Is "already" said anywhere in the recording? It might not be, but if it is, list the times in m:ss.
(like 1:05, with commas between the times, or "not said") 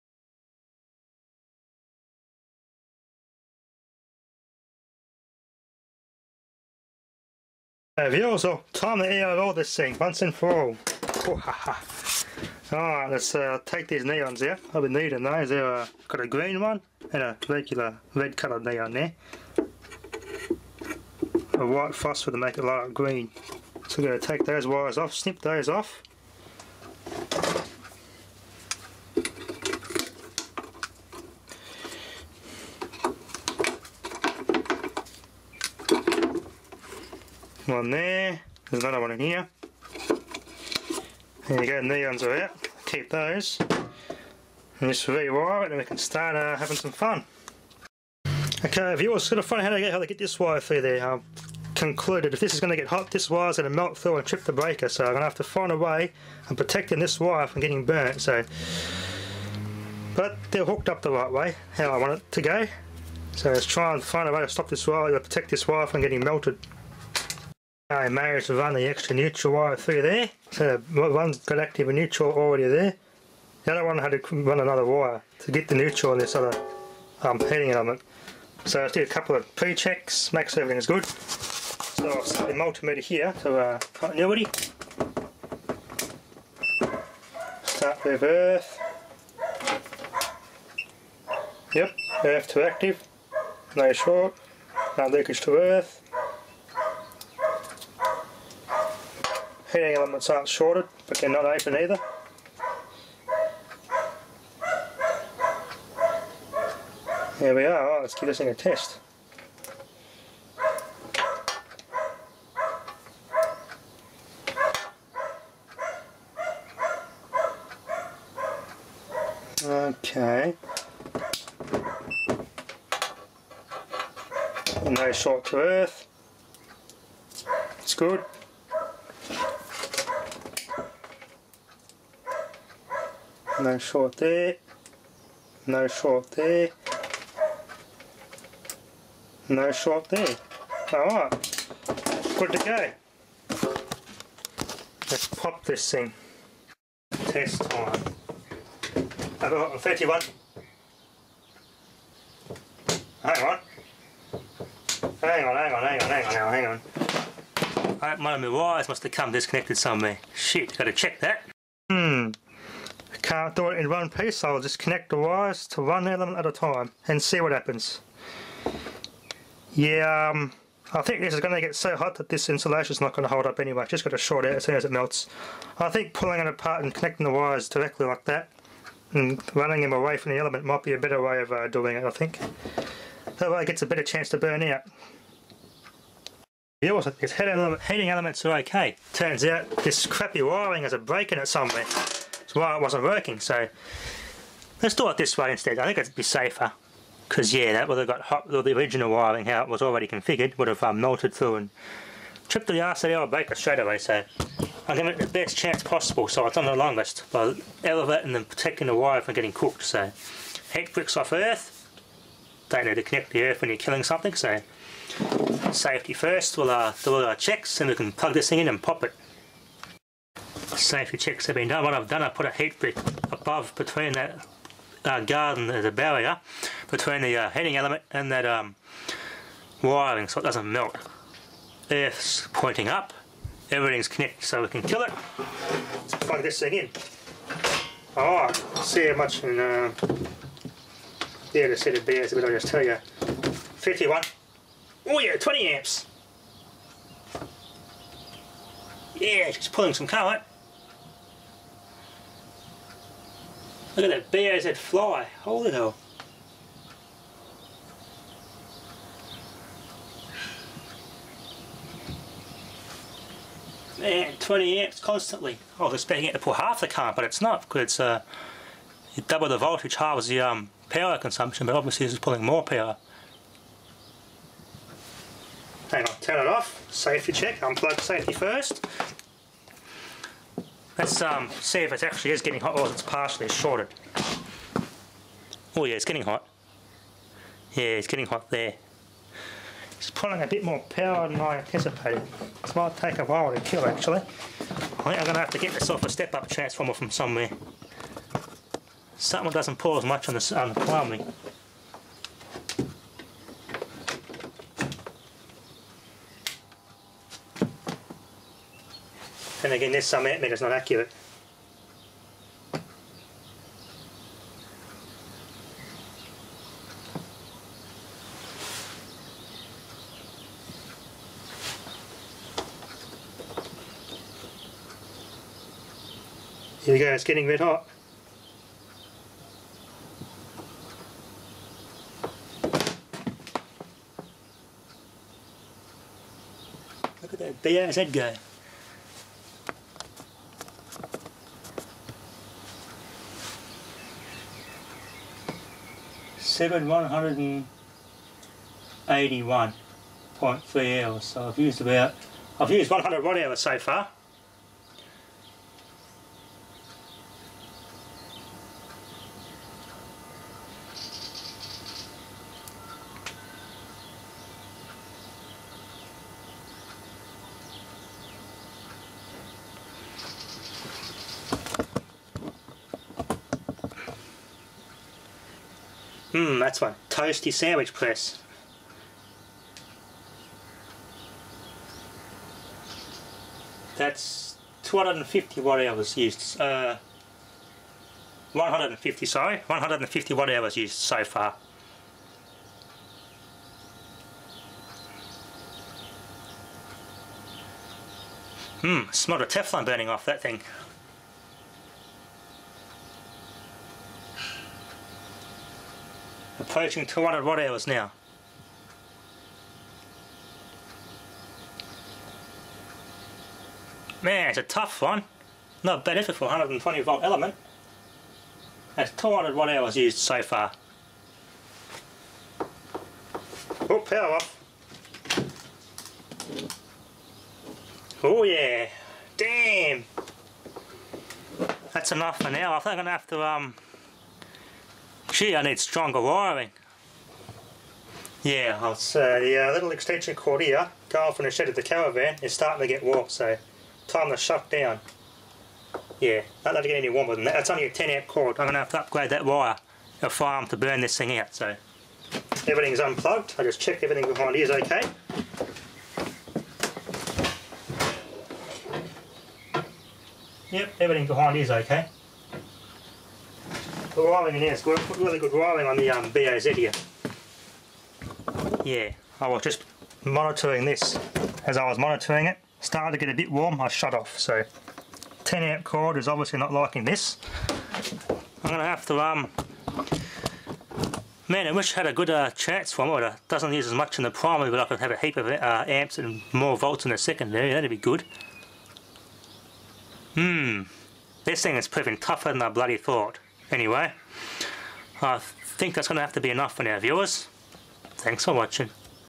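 1:12, 3:19.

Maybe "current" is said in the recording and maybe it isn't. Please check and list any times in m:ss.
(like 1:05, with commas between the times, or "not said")
4:10, 4:26.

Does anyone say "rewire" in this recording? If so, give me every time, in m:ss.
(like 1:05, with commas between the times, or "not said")
0:45.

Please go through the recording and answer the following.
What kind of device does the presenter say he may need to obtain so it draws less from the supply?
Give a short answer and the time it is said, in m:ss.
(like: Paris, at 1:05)
step-up transformer, at 4:56.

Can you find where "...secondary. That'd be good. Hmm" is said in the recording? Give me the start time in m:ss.
8:07.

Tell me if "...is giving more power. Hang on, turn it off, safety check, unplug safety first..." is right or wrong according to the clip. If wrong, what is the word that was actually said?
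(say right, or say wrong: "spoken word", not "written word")
wrong: "pulling", not "giving".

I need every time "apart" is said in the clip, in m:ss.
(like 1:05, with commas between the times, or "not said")
2:56.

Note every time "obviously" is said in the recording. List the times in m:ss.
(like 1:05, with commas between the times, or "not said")
4:31, 7:56.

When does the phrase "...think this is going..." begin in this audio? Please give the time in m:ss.
2:51.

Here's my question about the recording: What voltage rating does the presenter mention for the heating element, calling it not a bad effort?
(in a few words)
120 volt.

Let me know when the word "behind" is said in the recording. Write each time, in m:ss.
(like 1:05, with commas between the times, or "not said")
7:34, 7:41.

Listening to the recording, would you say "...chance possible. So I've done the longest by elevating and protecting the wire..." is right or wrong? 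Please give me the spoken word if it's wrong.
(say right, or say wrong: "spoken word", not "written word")
right.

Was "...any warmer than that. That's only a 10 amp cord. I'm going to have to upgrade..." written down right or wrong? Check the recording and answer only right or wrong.
right.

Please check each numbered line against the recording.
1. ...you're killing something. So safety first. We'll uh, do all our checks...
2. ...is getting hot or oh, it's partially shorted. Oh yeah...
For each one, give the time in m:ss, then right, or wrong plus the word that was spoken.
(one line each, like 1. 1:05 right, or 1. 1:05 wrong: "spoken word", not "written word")
1. 3:33 right
2. 4:42 right.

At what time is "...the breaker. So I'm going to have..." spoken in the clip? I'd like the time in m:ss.
0:54.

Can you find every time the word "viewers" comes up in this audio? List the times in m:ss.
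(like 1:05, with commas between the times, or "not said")
0:48, 8:16.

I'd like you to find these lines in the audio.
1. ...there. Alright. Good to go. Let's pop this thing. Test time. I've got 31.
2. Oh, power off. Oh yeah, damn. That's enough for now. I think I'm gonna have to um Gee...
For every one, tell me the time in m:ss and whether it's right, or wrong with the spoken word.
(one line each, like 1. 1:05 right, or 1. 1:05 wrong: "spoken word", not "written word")
1. 2:20 right
2. 7:03 right.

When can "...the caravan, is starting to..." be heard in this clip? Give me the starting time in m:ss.
7:21.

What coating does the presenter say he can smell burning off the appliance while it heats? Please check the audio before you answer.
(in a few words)
Teflon.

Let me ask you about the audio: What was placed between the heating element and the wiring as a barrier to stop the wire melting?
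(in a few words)
heat brick.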